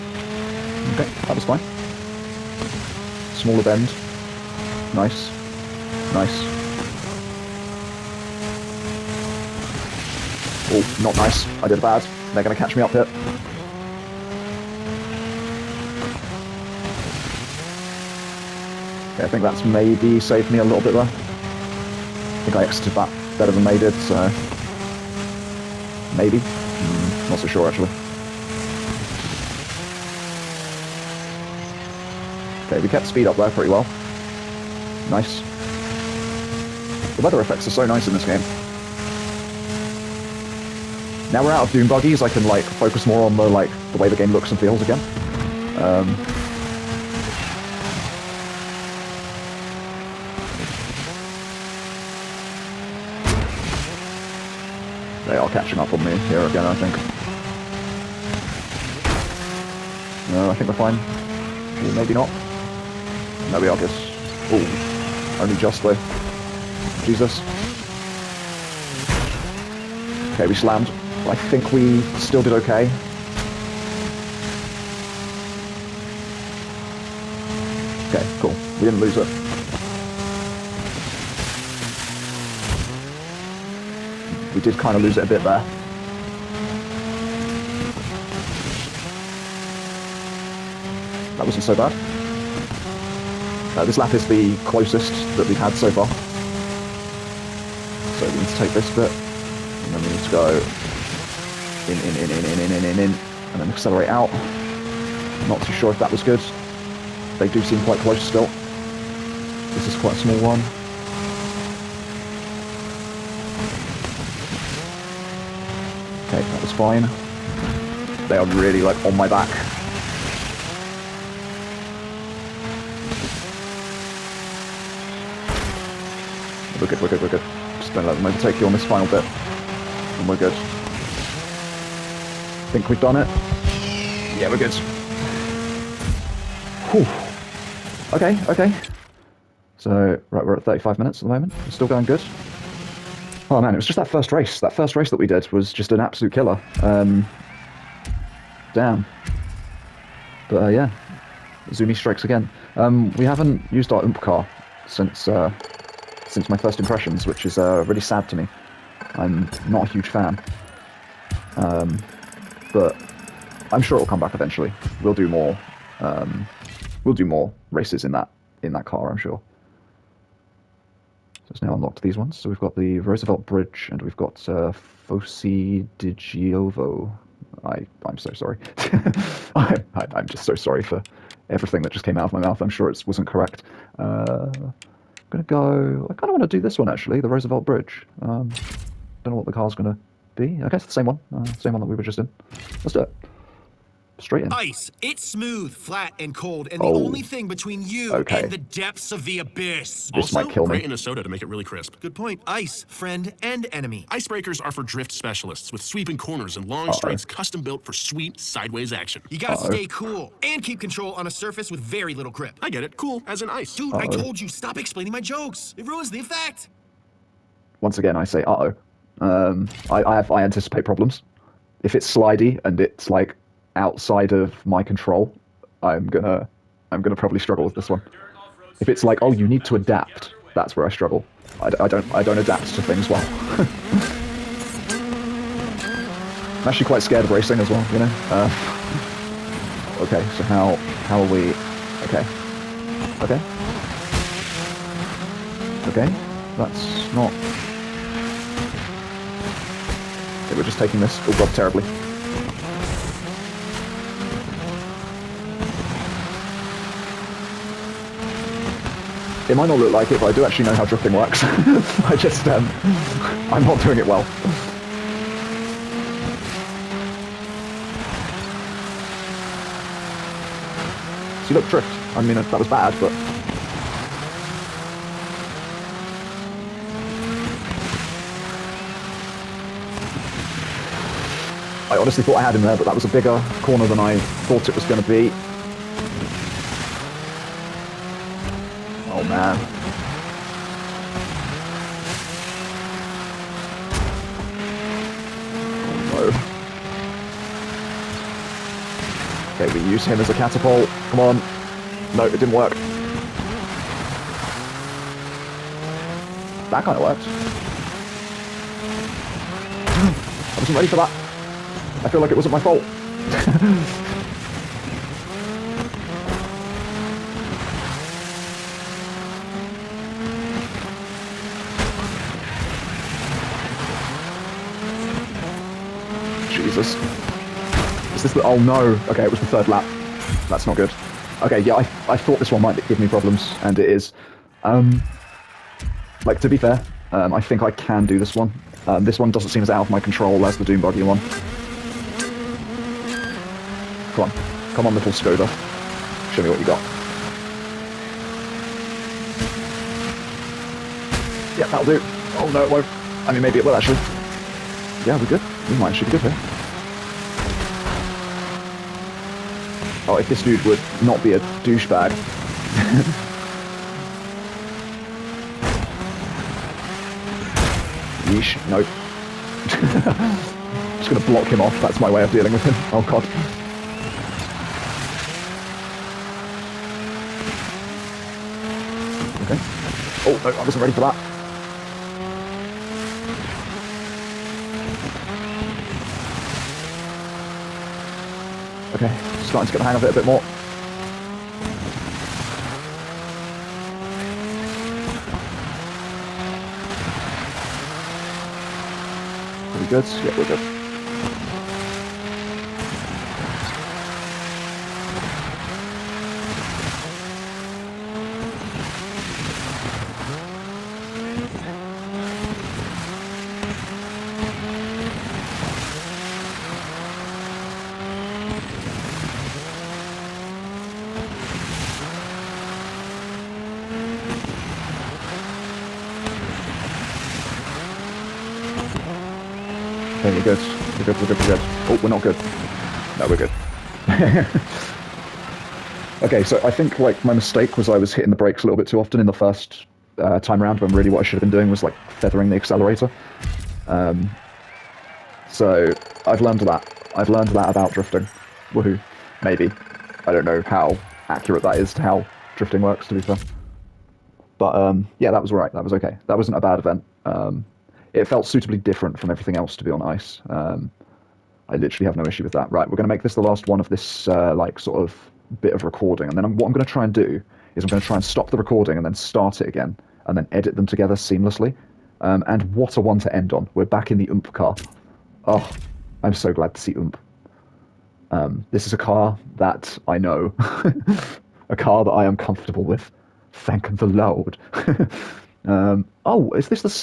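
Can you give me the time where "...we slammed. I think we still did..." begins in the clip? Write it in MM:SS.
01:10.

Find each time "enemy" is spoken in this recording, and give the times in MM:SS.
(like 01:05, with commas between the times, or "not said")
03:23.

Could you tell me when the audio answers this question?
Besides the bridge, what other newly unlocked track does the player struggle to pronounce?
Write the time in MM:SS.
02:55.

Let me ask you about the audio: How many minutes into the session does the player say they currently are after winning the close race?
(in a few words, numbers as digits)
35.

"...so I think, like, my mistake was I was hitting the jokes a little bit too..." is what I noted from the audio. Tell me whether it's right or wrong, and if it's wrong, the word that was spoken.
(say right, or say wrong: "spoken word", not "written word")
wrong: "brakes", not "jokes".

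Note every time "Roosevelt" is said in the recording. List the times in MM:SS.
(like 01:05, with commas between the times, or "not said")
02:53, 03:07.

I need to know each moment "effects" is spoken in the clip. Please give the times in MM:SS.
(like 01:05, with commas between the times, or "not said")
00:37, 03:36.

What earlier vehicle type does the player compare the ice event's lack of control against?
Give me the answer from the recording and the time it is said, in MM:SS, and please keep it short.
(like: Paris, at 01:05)
Doom Buggy, at 05:40.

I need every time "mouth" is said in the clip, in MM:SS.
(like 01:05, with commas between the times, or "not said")
03:02.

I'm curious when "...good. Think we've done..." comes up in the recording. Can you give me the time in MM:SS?
02:10.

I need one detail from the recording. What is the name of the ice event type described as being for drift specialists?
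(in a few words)
Icebreakers.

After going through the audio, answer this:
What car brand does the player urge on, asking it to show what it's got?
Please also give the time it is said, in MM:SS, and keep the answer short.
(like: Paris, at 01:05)
Skoda, at 05:45.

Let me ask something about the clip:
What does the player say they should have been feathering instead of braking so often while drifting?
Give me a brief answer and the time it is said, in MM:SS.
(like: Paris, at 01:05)
the accelerator, at 07:22.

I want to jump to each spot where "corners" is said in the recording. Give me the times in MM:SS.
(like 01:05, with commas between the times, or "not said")
03:26, 04:43.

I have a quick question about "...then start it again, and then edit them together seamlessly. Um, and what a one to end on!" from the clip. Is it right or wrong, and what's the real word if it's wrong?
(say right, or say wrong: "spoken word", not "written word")
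right.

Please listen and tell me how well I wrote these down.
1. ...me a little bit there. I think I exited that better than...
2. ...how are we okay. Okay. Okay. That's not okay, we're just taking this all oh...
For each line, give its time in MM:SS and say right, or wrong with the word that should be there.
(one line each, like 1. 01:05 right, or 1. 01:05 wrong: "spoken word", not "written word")
1. 00:20 right
2. 04:01 right.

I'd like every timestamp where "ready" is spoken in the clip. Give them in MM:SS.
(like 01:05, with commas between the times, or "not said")
05:10, 06:20.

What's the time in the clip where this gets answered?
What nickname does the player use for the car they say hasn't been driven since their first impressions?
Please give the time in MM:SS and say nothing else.
02:34.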